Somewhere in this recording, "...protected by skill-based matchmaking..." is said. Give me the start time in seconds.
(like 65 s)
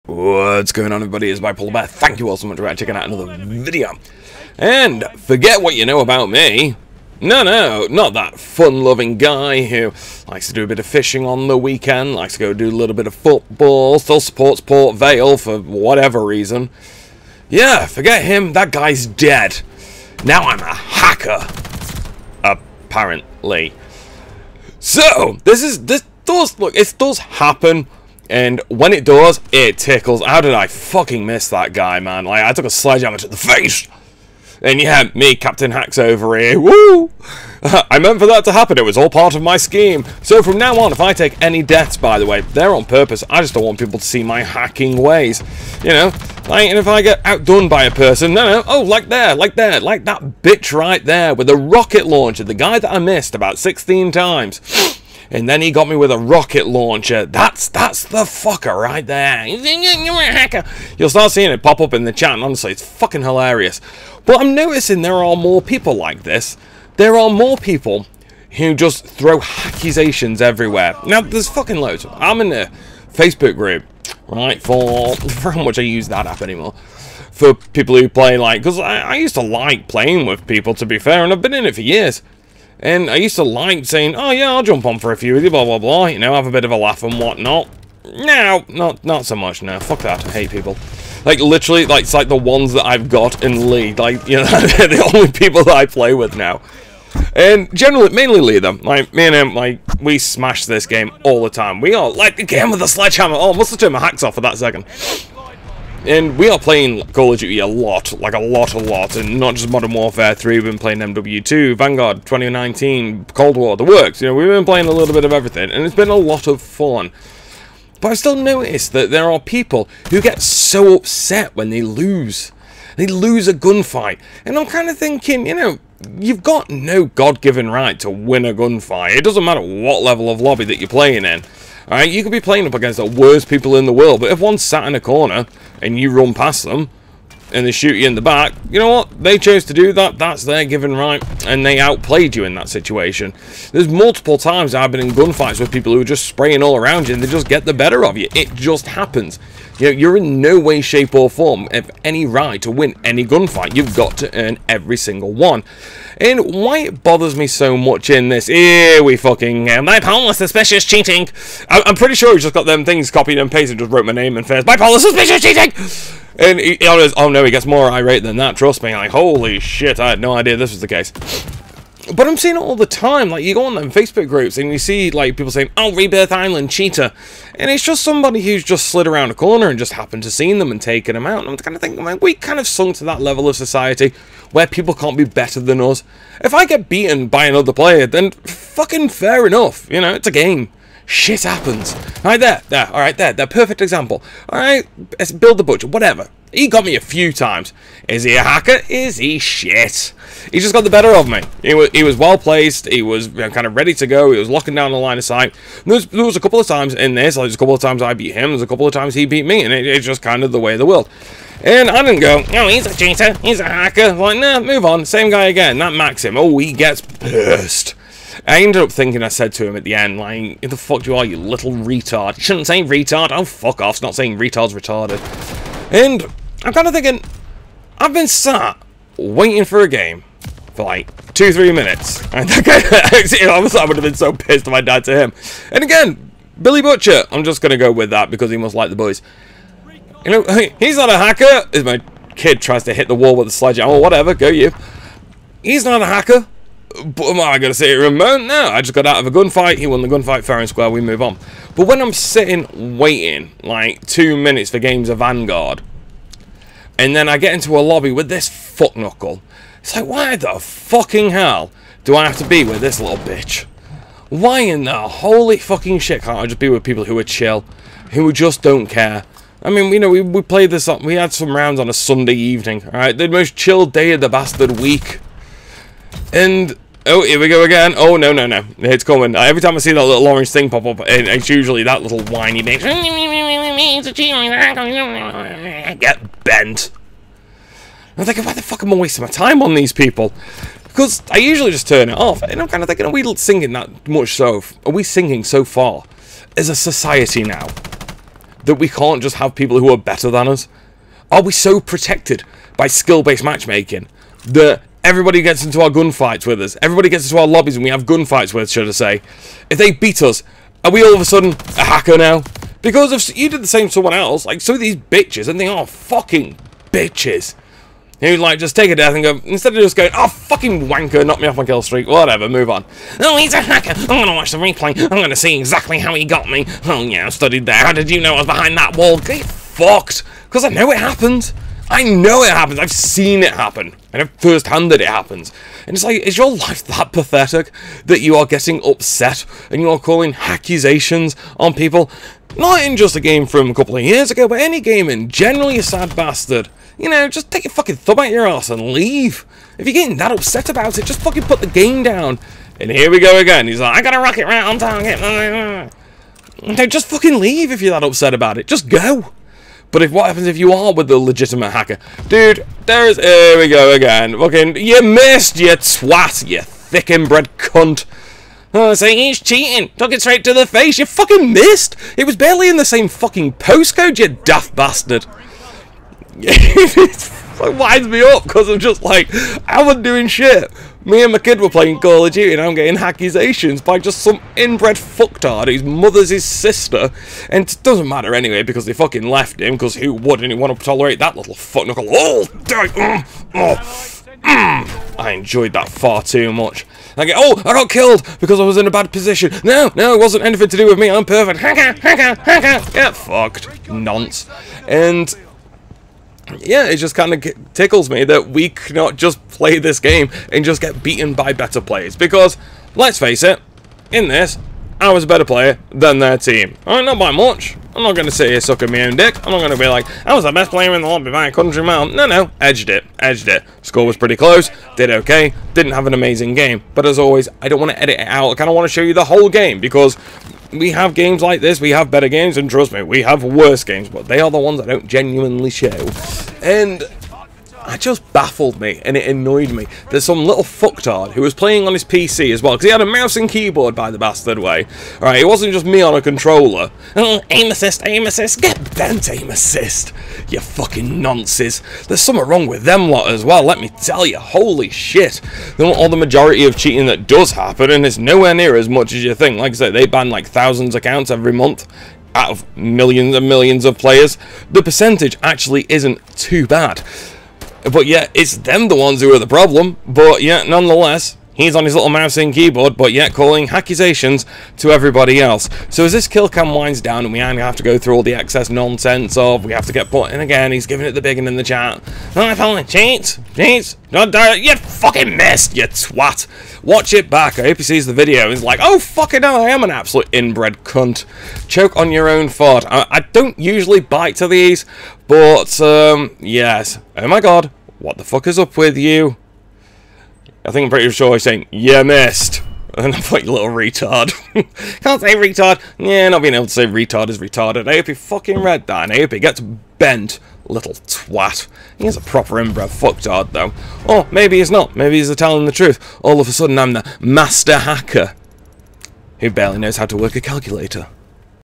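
301 s.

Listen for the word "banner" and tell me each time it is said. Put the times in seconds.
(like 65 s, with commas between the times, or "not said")
not said.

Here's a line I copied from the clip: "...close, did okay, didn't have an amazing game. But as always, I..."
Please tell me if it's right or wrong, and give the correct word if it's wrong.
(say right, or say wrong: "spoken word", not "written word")
right.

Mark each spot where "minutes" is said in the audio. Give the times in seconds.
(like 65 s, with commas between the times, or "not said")
231 s, 254 s.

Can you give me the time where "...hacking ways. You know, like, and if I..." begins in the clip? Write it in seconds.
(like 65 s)
44 s.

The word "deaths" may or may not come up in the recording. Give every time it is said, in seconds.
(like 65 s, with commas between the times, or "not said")
41 s, 318 s.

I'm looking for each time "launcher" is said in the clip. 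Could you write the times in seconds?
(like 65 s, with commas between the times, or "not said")
52 s, 56 s.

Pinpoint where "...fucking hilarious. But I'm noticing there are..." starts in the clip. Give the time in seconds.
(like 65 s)
62 s.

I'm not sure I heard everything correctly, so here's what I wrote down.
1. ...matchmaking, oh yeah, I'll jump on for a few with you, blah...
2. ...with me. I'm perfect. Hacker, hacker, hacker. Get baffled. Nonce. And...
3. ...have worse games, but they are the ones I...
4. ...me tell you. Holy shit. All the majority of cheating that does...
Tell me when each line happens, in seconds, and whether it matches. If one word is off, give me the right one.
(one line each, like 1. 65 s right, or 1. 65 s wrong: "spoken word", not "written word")
1. 83 s wrong: "saying", not "matchmaking"
2. 400 s wrong: "fucked", not "baffled"
3. 433 s right
4. 453 s right.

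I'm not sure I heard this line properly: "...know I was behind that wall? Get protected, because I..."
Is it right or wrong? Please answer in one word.
wrong.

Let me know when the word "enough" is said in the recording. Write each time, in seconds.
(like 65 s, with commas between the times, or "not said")
189 s.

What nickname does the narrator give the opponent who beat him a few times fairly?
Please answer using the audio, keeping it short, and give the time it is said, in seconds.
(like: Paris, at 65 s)
Billy Butcher, at 236 s.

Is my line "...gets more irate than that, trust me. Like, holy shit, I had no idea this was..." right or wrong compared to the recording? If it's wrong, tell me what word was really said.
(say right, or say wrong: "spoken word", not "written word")
right.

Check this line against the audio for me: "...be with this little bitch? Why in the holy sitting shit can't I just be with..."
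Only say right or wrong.
wrong.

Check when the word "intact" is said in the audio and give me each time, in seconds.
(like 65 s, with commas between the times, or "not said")
not said.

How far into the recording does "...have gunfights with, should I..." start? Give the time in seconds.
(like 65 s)
307 s.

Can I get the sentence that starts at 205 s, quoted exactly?
There was, there was, a couple of times in this.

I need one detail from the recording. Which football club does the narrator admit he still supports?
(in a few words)
Port Vale.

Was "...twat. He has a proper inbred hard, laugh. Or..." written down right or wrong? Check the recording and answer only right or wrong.
wrong.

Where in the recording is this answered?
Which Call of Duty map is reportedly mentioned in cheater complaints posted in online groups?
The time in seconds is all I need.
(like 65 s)
175 s.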